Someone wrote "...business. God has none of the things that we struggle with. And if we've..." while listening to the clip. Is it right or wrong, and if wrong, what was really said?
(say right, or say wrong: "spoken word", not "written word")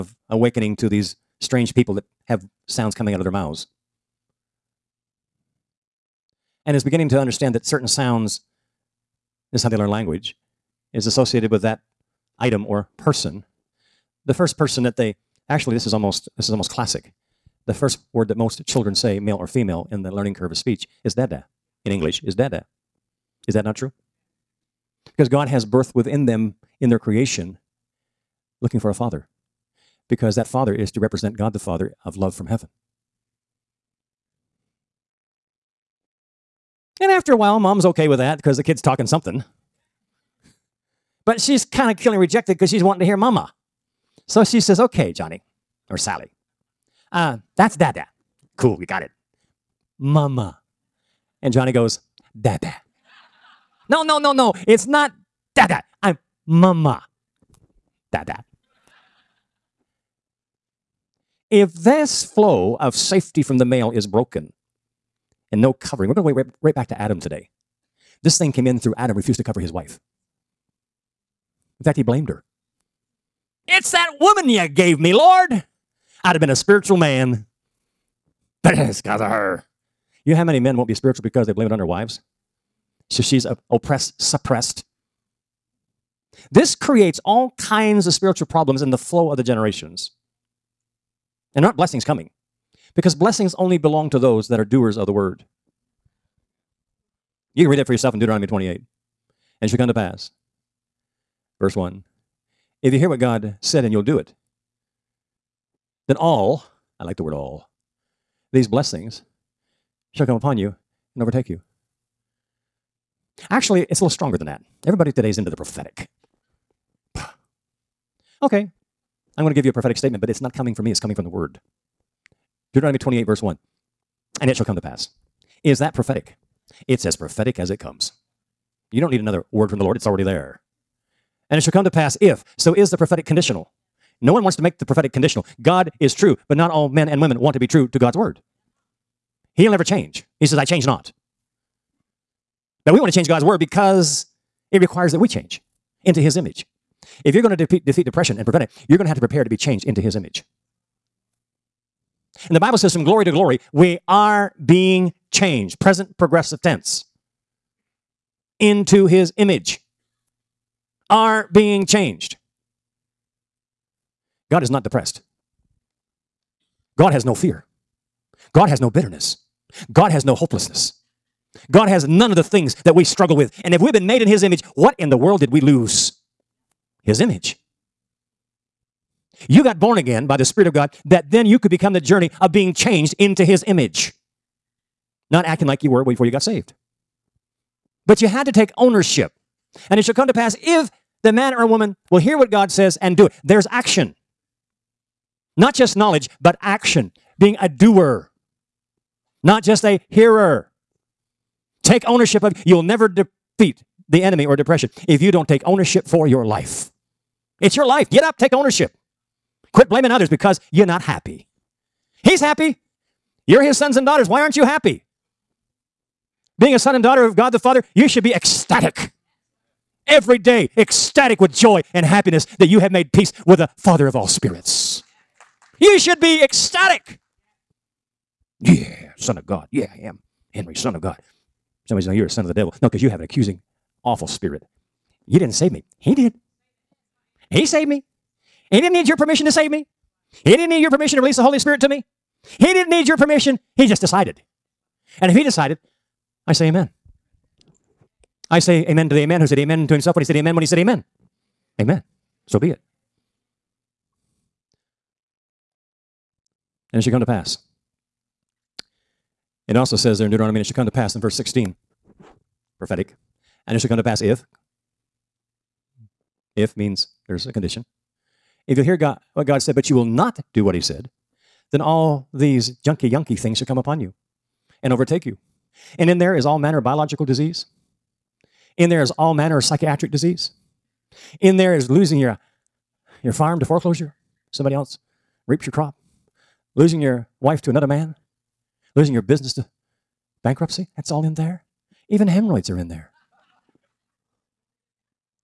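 wrong: "hopelessness", not "business".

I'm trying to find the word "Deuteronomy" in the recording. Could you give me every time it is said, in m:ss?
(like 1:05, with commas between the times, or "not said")
1:38, 2:02, 4:20.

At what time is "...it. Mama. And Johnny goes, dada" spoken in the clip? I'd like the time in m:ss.
0:49.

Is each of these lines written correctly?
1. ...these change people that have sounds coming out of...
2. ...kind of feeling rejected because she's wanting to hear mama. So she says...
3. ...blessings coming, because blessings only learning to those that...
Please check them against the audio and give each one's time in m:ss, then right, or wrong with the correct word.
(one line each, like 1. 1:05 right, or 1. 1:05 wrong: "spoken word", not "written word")
1. 0:00 wrong: "strange", not "change"
2. 0:41 right
3. 1:31 wrong: "belong", not "learning".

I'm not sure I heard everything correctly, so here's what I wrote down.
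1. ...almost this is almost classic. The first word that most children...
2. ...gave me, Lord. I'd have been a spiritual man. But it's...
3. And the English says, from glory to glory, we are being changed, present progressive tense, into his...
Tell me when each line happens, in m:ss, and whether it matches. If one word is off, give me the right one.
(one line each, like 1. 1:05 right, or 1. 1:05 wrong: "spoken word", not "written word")
1. 0:15 right
2. 1:14 right
3. 2:32 wrong: "Bible", not "English".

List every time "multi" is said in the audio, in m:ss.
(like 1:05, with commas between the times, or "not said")
not said.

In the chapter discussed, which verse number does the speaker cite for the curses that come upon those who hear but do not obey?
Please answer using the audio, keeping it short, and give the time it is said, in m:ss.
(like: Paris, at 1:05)
16, at 4:21.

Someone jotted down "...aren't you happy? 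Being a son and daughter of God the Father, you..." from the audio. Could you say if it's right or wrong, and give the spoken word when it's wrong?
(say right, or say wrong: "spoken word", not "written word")
right.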